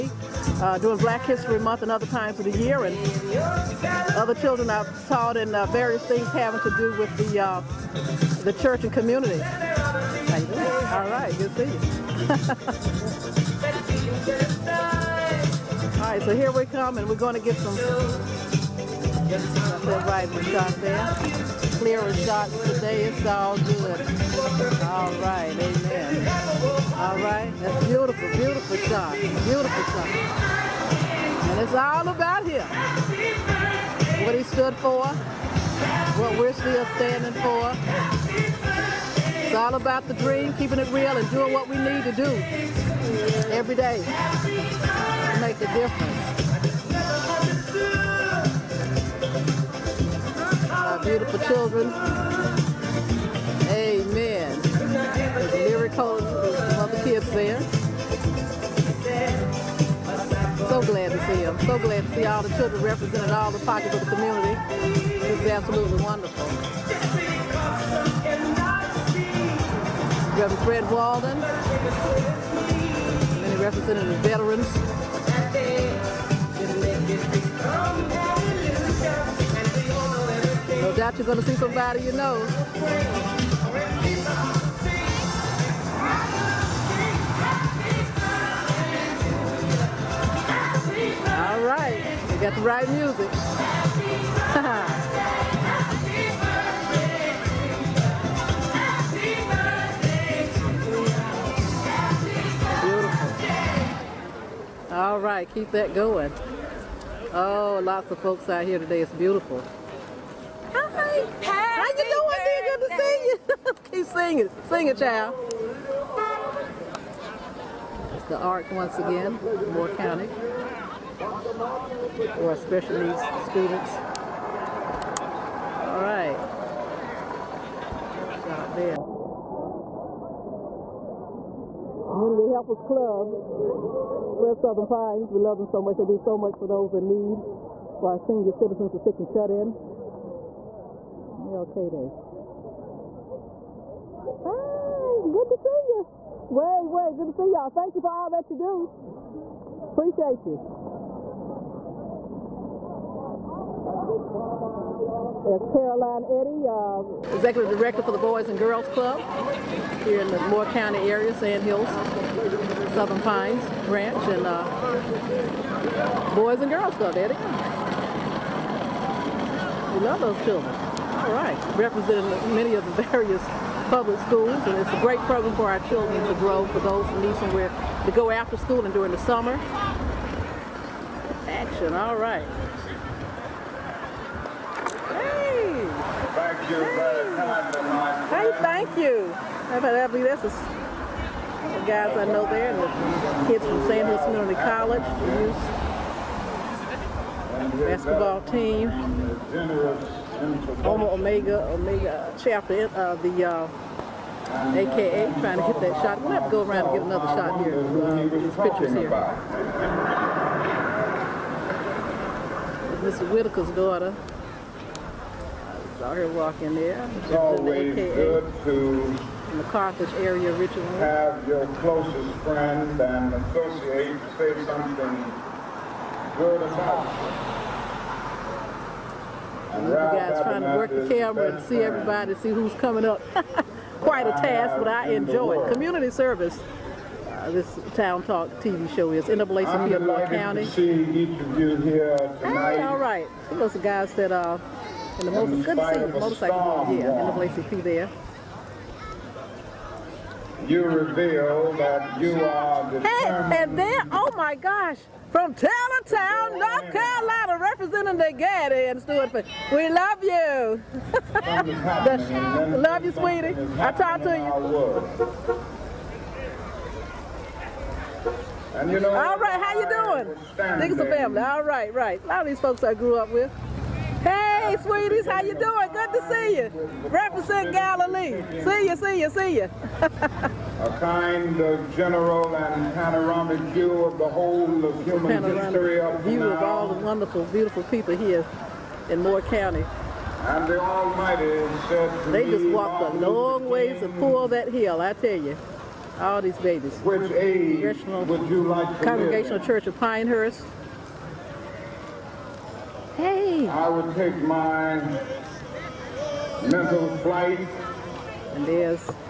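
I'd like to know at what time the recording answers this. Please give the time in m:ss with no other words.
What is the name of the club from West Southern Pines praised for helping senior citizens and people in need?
2:12.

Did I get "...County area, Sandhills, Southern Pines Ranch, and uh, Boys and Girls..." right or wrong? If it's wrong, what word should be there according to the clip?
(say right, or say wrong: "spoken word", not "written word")
right.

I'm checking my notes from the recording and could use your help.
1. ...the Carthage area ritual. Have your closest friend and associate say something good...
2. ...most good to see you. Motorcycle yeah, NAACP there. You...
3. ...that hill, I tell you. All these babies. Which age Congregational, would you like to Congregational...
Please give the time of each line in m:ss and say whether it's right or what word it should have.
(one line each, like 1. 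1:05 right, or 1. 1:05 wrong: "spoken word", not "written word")
1. 3:39 right
2. 4:05 right
3. 4:54 right.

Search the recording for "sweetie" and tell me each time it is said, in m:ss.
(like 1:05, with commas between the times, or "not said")
4:23, 4:34.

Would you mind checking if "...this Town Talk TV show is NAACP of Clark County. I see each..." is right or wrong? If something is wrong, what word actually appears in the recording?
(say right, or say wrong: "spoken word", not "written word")
right.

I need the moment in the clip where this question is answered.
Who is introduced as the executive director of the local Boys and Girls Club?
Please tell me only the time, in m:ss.
2:35.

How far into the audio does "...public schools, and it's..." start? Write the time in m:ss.
2:53.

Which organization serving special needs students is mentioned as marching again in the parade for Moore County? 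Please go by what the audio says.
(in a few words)
The ARC.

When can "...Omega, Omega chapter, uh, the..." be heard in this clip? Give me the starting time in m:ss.
3:21.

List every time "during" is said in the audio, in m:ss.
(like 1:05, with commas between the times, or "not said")
0:00, 2:58.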